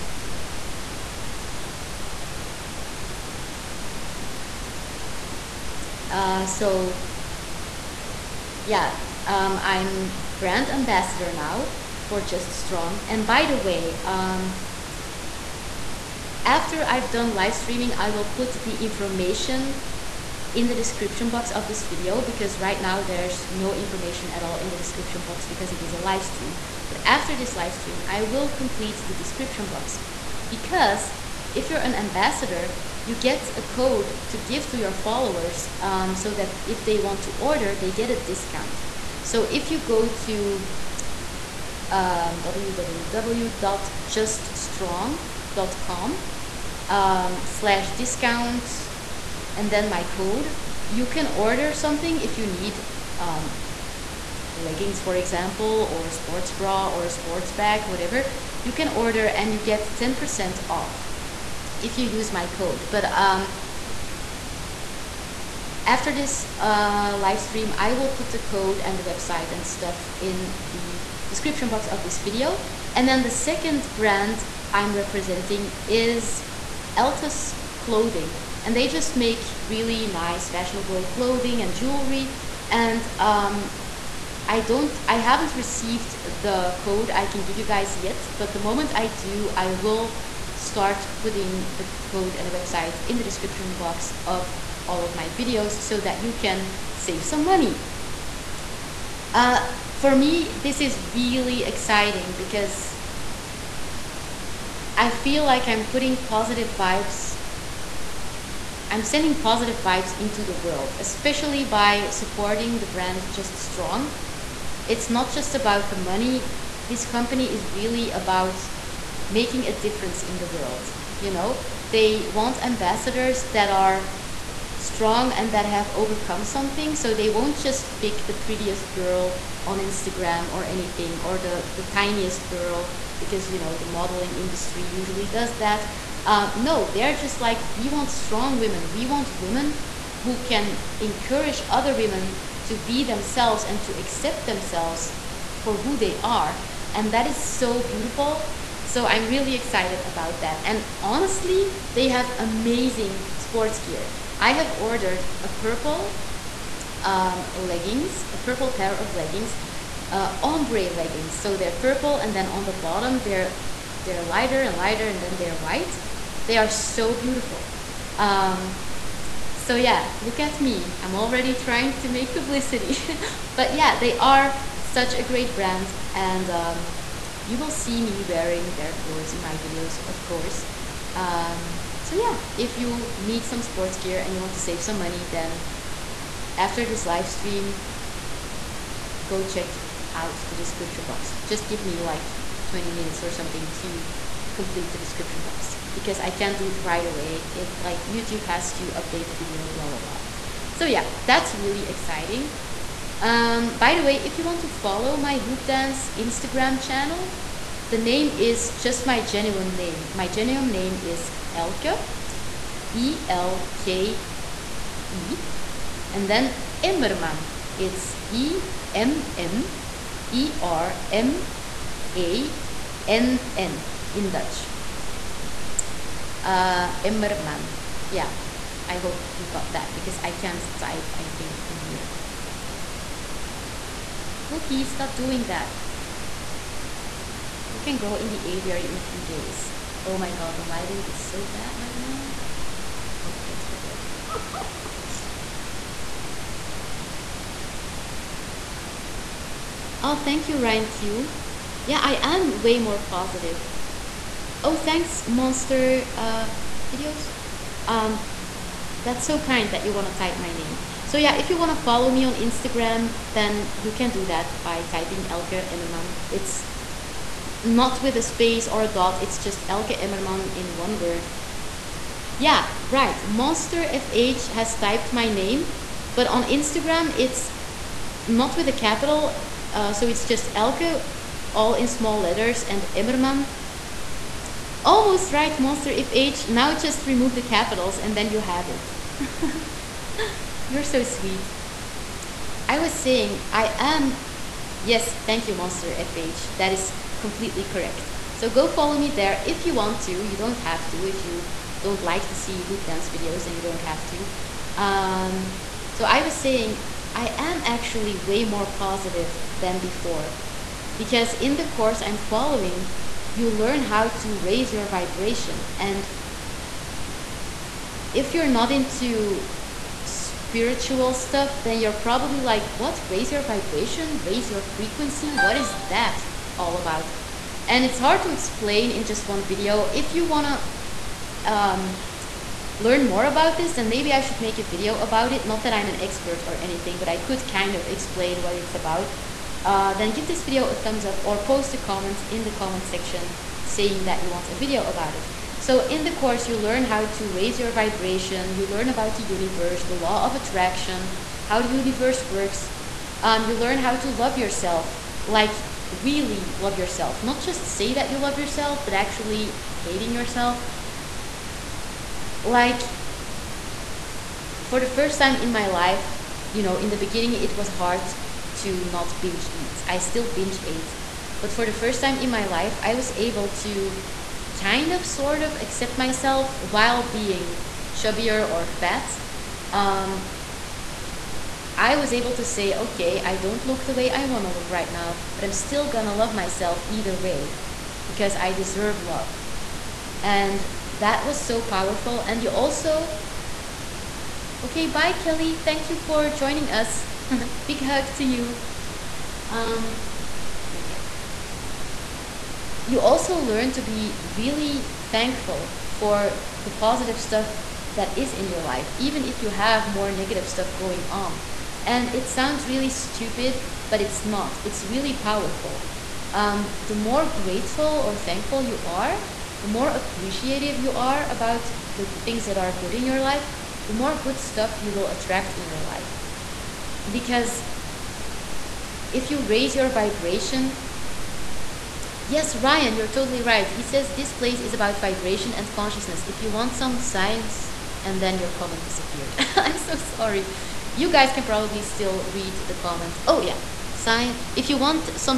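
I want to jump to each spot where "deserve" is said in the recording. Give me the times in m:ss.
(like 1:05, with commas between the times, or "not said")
6:28.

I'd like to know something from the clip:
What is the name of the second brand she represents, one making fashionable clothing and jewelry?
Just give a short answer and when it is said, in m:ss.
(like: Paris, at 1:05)
Altus Clothing, at 1:16.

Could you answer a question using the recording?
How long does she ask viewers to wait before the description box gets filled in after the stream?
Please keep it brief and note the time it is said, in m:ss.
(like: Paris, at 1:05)
20 minutes, at 3:12.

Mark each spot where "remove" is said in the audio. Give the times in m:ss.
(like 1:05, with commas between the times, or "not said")
4:47.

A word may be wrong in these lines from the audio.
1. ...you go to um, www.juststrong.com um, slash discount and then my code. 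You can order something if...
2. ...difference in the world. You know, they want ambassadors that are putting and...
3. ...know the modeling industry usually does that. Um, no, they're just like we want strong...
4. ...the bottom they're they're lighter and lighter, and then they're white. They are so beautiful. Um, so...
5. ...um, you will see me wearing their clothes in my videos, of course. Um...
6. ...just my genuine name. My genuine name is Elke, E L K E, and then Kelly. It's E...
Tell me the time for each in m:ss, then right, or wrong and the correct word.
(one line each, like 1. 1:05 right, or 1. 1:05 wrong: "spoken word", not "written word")
1. 0:39 right
2. 1:59 wrong: "strong", not "putting"
3. 2:13 right
4. 2:42 right
5. 2:56 right
6. 3:28 wrong: "Emmermann", not "Kelly".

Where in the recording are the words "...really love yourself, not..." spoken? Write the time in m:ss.
5:55.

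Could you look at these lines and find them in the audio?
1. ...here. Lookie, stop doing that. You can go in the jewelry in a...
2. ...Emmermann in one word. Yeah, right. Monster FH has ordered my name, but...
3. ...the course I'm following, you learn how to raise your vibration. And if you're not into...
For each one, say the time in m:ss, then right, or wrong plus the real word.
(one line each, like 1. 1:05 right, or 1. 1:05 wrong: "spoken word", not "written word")
1. 3:51 wrong: "aviary", not "jewelry"
2. 4:30 wrong: "typed", not "ordered"
3. 5:11 right.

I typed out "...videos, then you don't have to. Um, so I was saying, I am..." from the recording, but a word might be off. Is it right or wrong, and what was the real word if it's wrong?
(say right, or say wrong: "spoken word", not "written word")
right.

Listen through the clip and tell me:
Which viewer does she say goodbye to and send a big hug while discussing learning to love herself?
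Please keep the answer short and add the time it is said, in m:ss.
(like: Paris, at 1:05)
Kelly, at 6:35.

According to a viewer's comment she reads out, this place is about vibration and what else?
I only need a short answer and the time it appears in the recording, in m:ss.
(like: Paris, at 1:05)
consciousness, at 7:15.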